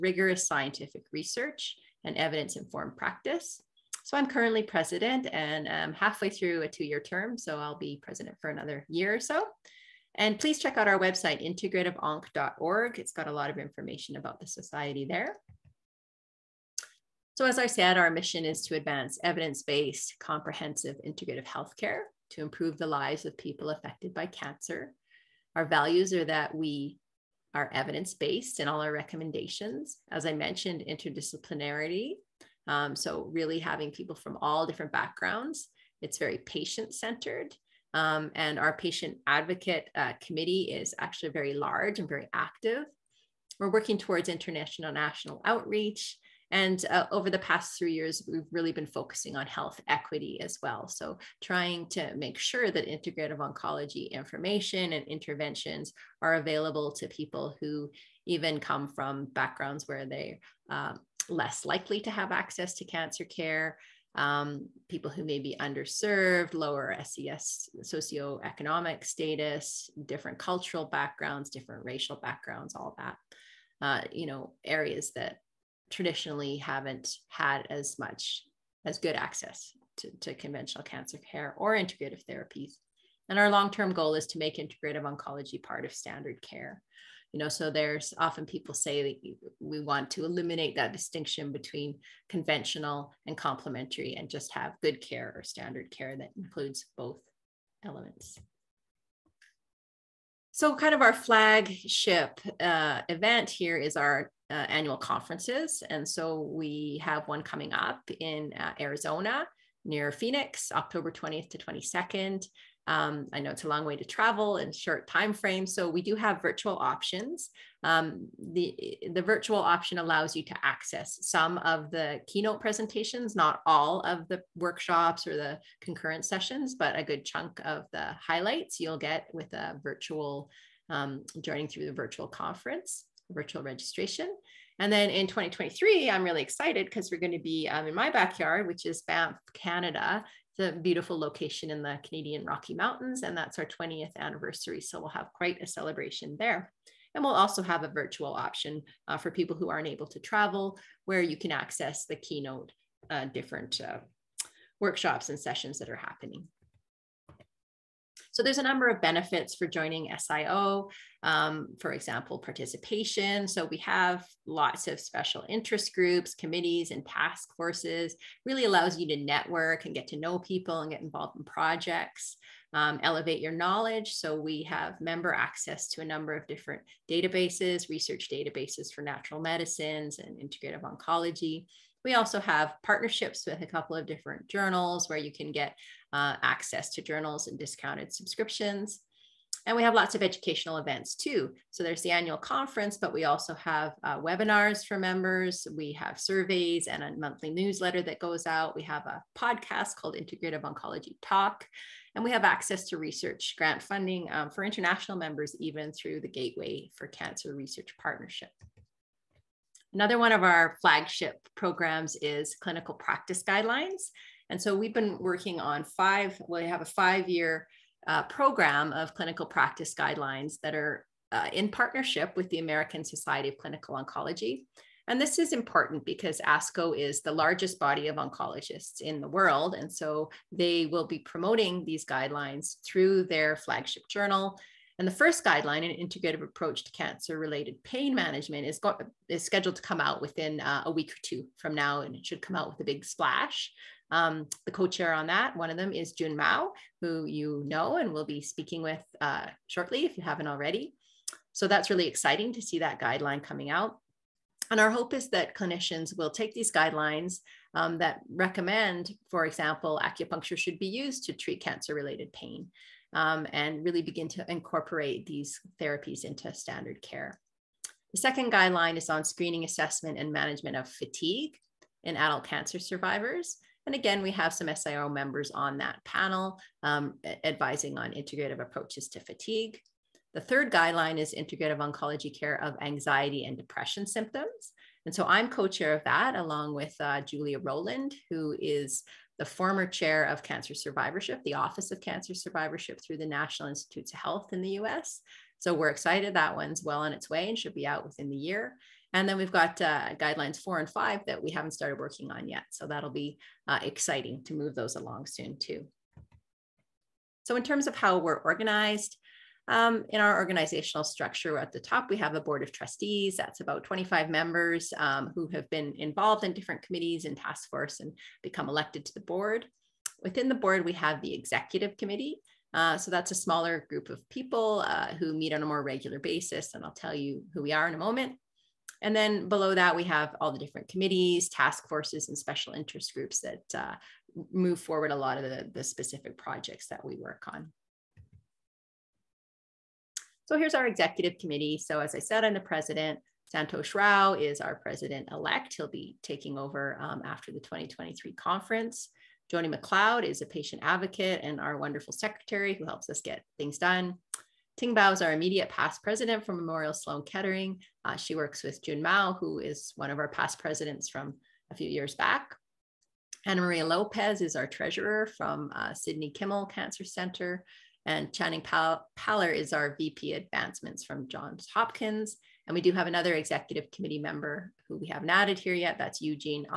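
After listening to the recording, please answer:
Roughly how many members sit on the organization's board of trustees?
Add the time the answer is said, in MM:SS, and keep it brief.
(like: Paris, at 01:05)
25, at 05:13.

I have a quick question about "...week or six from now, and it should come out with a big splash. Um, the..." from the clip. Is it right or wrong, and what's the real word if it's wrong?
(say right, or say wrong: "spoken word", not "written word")
wrong: "two", not "six".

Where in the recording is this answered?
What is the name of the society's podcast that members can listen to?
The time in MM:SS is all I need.
03:20.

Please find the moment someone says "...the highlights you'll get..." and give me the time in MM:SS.
02:07.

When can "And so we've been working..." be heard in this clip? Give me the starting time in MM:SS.
03:34.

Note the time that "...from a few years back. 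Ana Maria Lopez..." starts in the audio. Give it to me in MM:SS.
06:01.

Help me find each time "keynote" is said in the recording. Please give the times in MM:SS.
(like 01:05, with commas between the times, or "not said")
02:02, 02:32.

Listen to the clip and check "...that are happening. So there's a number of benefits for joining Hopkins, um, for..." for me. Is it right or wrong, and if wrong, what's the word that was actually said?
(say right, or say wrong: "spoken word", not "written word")
wrong: "SIO", not "Hopkins".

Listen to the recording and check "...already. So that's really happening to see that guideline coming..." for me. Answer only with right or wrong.
wrong.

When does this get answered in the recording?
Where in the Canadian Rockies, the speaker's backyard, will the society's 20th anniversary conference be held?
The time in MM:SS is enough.
02:19.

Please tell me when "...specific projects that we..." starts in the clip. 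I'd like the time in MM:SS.
05:35.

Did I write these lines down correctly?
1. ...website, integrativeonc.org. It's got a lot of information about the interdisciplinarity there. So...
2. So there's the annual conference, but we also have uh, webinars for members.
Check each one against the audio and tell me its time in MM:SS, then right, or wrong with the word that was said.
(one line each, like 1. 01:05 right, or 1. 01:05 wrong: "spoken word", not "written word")
1. 00:10 wrong: "society", not "interdisciplinarity"
2. 03:11 right.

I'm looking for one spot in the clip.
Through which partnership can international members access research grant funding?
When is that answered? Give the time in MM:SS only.
03:26.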